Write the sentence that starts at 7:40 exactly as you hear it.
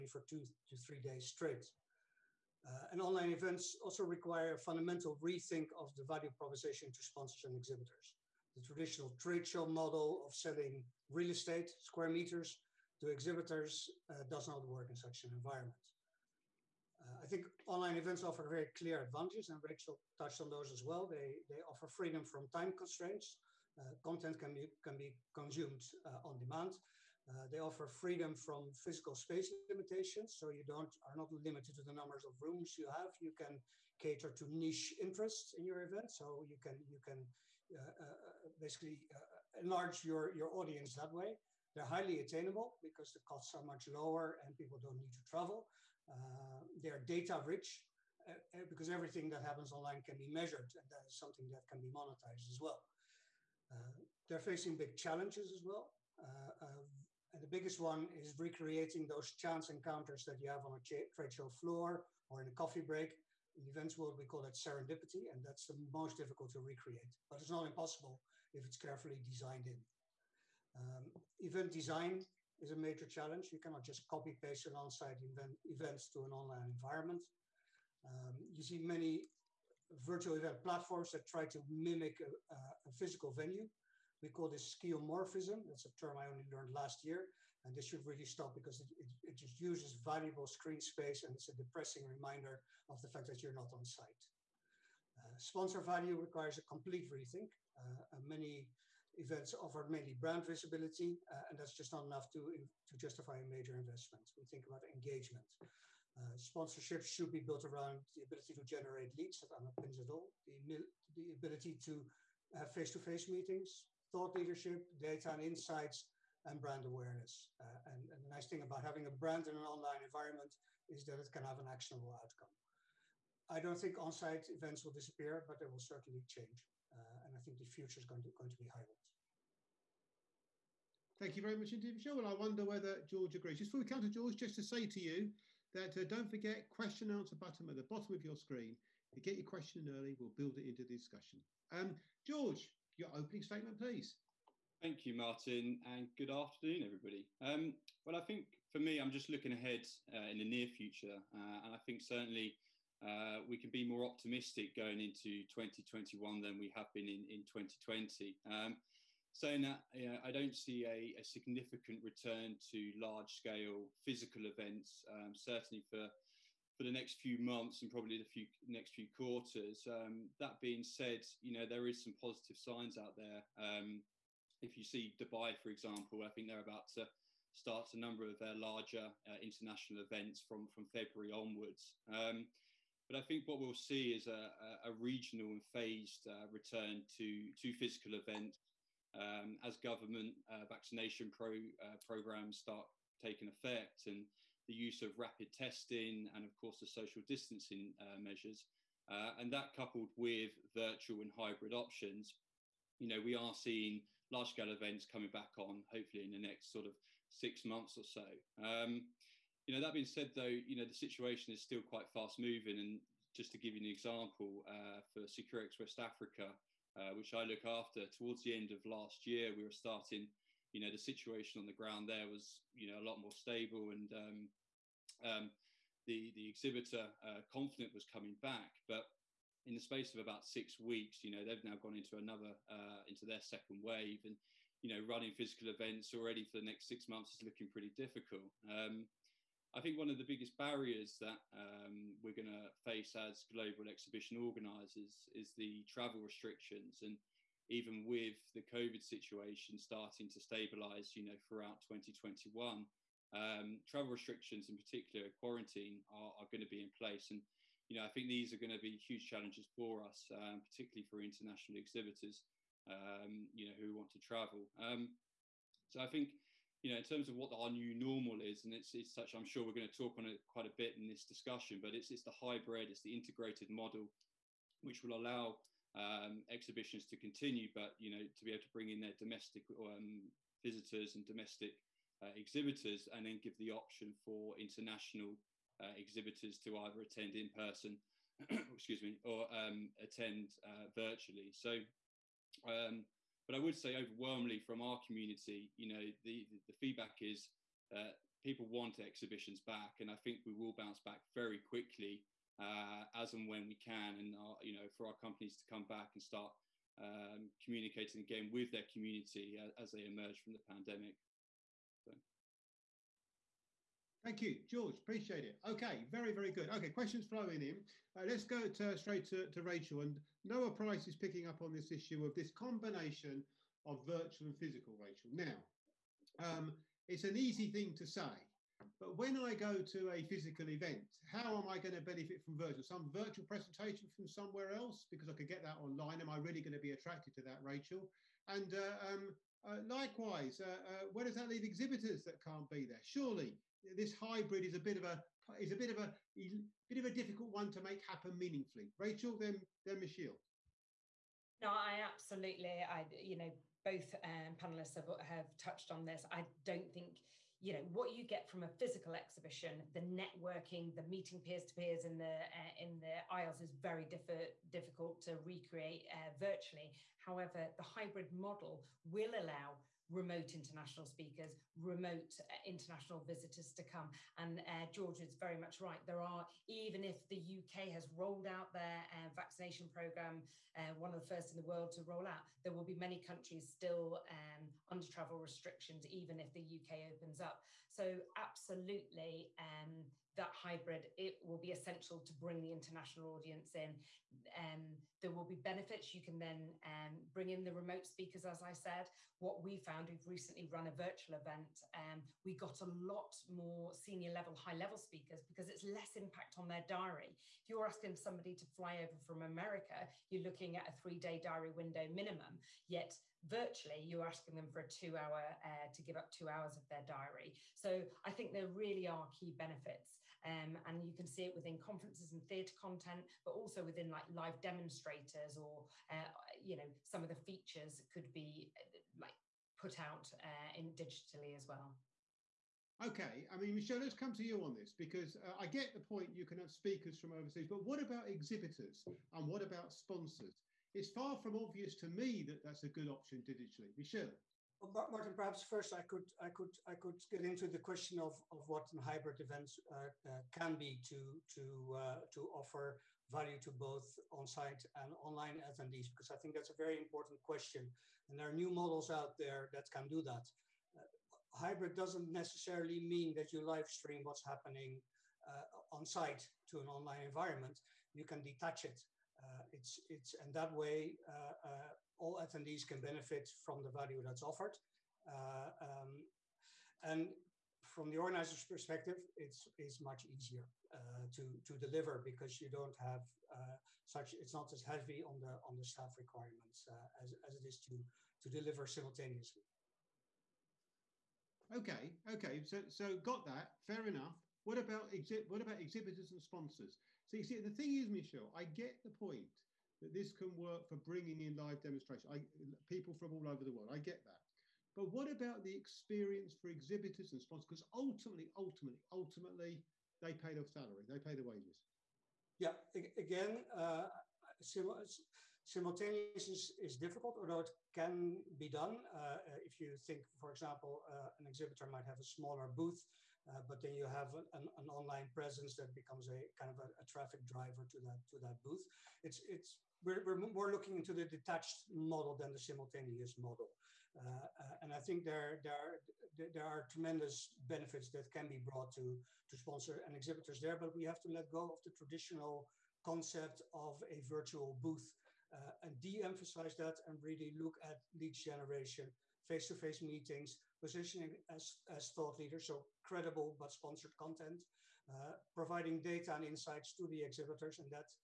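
Uh, hybrid doesn't necessarily mean that you live stream what's happening uh, on-site to an online environment.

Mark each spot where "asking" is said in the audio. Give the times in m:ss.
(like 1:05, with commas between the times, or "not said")
6:47, 6:54.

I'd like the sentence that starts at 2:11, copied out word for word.
Thank you very much indeed, Michelle.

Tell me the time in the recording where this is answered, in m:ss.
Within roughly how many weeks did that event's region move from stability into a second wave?
3:50.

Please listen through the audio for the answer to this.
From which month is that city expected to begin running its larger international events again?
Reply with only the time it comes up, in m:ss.
3:00.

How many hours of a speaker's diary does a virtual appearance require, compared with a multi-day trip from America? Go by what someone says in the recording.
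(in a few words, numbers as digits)
2 hours.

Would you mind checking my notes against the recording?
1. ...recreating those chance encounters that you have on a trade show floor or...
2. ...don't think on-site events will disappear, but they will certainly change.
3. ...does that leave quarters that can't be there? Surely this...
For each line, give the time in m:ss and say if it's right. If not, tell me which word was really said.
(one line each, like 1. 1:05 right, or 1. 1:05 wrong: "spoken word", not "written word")
1. 0:58 right
2. 2:03 right
3. 5:41 wrong: "exhibitors", not "quarters".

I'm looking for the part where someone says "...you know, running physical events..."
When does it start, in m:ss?
3:54.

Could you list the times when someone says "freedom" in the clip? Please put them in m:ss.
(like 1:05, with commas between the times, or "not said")
0:21, 0:27.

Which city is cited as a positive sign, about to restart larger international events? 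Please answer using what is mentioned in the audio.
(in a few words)
Dubai.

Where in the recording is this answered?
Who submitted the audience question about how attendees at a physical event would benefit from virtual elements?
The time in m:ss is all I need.
5:20.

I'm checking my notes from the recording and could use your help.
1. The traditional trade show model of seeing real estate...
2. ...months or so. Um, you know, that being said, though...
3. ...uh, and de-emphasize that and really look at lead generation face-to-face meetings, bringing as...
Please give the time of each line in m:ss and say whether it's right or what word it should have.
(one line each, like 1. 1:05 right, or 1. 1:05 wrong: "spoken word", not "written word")
1. 0:08 wrong: "selling", not "seeing"
2. 3:27 right
3. 9:05 wrong: "positioning", not "bringing".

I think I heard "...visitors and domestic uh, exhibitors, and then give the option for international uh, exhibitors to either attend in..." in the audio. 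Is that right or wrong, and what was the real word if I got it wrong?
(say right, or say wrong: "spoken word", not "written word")
right.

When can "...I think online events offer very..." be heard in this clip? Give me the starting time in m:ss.
0:17.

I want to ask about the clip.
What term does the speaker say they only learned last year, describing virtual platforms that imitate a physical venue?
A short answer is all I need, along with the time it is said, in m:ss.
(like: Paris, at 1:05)
skeuomorphism, at 1:24.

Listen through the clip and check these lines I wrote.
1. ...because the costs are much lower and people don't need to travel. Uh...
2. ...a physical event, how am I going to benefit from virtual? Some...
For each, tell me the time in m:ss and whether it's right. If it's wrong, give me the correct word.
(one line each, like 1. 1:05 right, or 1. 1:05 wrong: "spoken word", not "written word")
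1. 0:42 right
2. 5:30 right.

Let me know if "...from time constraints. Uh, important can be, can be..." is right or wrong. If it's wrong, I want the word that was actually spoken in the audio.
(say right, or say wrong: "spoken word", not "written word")
wrong: "content", not "important".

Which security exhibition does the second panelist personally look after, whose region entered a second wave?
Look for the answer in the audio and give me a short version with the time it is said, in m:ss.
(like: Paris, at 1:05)
Securex West Africa, at 3:35.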